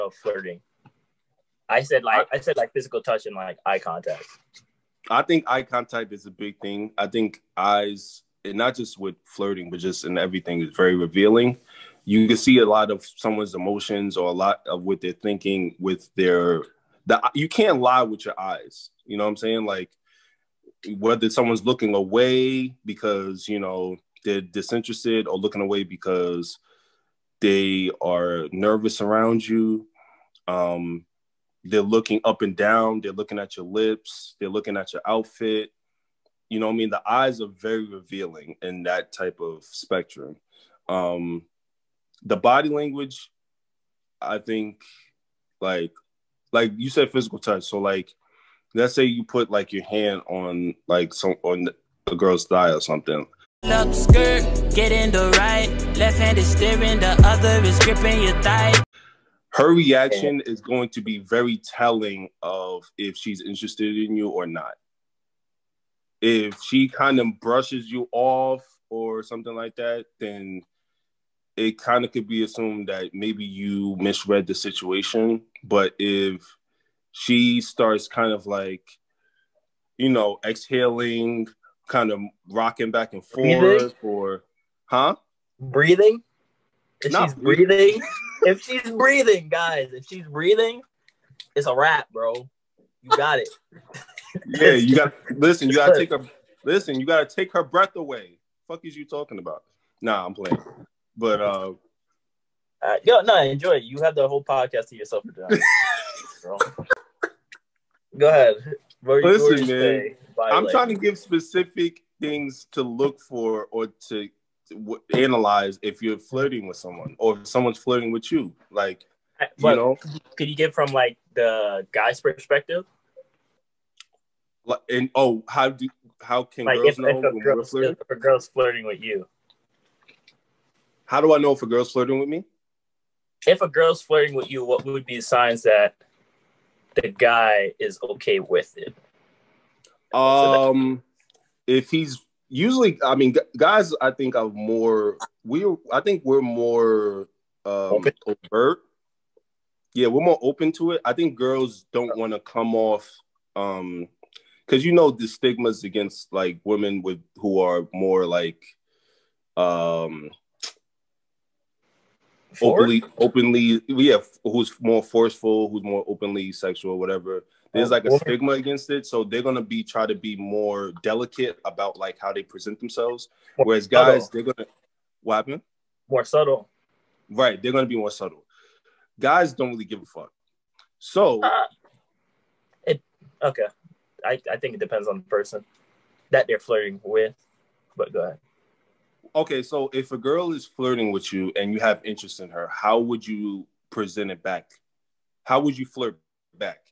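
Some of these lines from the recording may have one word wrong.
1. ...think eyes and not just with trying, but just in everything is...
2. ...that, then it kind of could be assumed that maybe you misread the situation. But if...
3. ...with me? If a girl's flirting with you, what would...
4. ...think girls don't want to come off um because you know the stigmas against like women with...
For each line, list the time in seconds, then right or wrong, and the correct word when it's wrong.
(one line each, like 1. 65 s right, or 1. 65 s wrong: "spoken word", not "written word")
1. 7 s wrong: "flirting", not "trying"
2. 69 s right
3. 132 s right
4. 151 s right.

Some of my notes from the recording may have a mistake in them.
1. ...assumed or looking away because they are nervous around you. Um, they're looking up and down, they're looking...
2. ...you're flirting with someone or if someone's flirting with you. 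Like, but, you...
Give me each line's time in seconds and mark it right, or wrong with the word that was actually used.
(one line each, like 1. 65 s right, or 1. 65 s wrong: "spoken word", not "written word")
1. 24 s wrong: "disinterested", not "assumed"
2. 116 s right.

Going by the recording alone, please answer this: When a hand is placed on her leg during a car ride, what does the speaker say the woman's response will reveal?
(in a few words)
If she's interested.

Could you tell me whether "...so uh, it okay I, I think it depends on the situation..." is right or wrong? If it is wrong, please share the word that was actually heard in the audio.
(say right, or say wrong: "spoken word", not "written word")
wrong: "person", not "situation".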